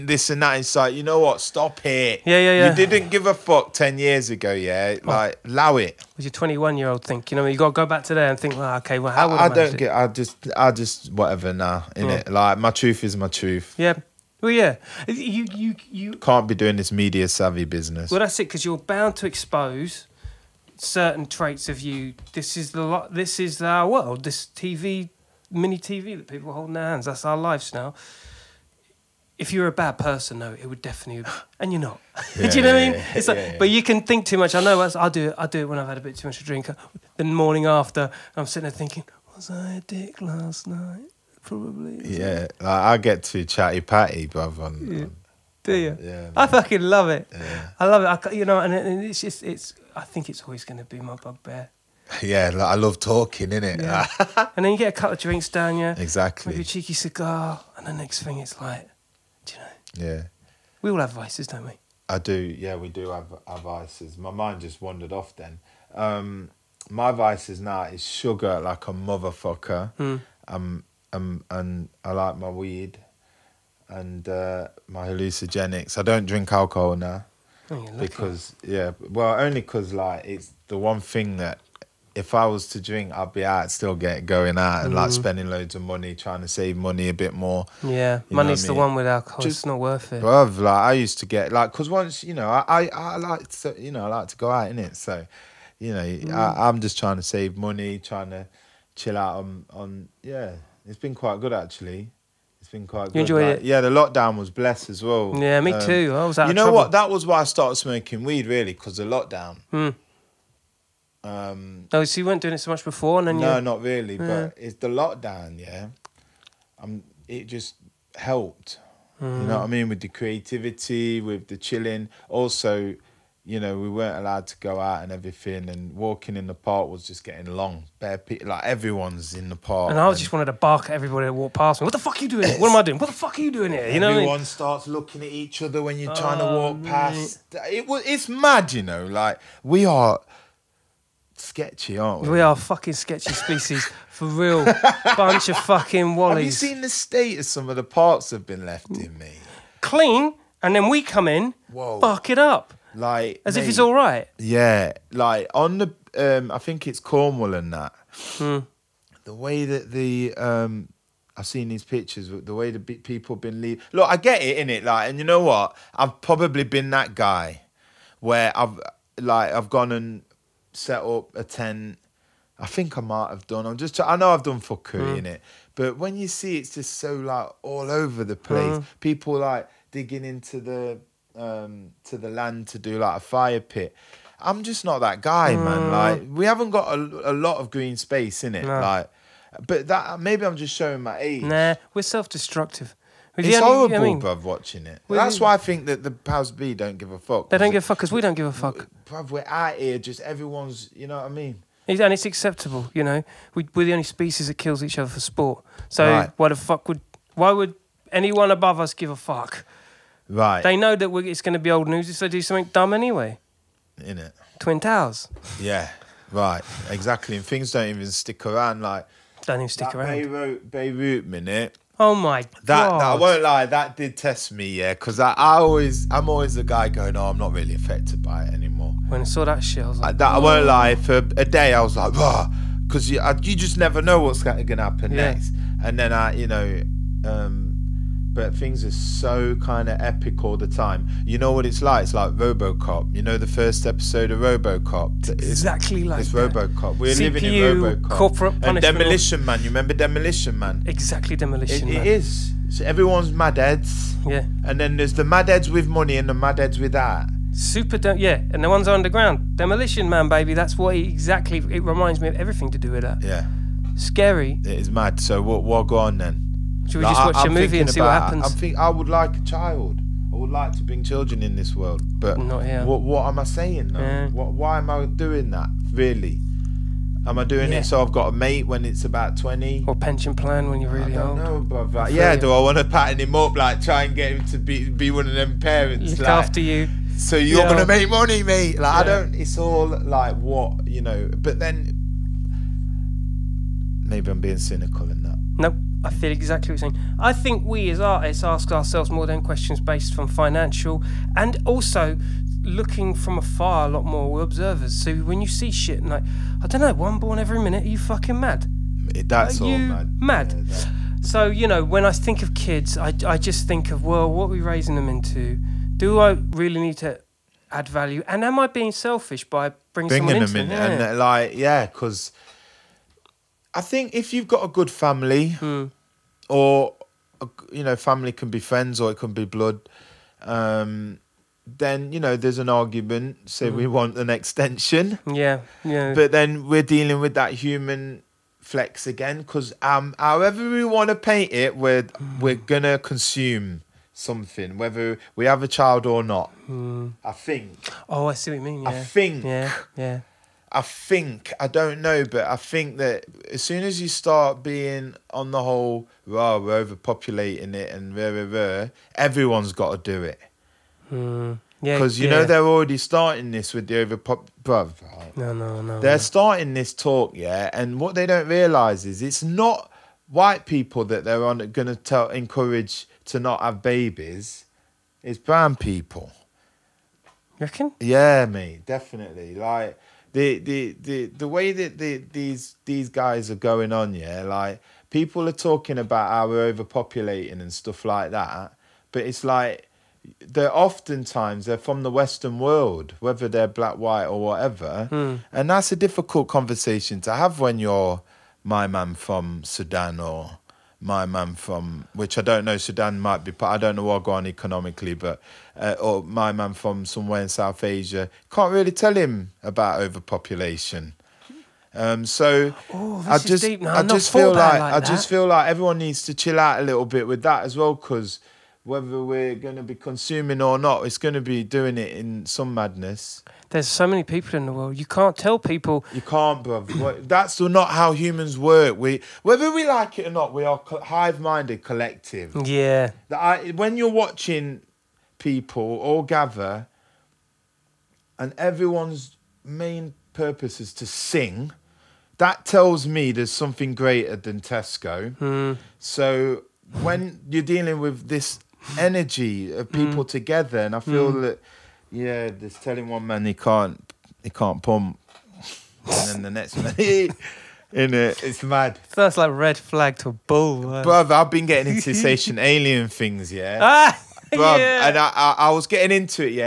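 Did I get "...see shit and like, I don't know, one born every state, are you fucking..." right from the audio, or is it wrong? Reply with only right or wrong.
wrong.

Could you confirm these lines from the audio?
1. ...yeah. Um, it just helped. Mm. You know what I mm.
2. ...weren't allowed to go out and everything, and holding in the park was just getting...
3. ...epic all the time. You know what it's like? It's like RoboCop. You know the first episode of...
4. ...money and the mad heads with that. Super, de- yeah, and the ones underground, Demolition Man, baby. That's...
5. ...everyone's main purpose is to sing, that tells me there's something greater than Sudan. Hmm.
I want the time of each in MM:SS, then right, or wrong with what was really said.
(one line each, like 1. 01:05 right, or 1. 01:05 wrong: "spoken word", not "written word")
1. 01:55 right
2. 02:03 wrong: "walking", not "holding"
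3. 03:59 right
4. 04:15 right
5. 07:18 wrong: "Tesco", not "Sudan".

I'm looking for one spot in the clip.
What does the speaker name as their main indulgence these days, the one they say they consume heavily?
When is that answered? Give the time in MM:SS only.
01:08.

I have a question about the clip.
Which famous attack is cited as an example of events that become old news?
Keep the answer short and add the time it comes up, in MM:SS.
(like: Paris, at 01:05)
Twin Towers, at 03:34.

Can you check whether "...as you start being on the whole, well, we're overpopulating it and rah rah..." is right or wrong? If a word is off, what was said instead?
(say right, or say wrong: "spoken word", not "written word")
right.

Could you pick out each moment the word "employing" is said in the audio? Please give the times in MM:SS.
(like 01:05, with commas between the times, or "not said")
not said.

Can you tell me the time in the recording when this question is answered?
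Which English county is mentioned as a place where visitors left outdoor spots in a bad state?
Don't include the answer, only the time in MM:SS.
02:36.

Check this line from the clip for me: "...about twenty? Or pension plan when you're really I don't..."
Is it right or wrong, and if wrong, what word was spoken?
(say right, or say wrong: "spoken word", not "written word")
right.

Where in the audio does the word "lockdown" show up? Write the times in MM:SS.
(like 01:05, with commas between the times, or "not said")
01:43, 01:49, 01:54.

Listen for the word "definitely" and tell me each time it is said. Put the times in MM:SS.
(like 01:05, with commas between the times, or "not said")
00:30, 06:18.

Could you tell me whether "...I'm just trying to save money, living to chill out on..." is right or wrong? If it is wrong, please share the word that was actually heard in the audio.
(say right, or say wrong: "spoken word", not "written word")
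wrong: "trying", not "living".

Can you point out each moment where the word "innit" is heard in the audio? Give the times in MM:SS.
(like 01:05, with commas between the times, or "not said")
00:53.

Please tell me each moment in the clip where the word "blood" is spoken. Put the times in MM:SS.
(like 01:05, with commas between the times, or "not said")
05:29.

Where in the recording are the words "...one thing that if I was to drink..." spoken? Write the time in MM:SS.
01:20.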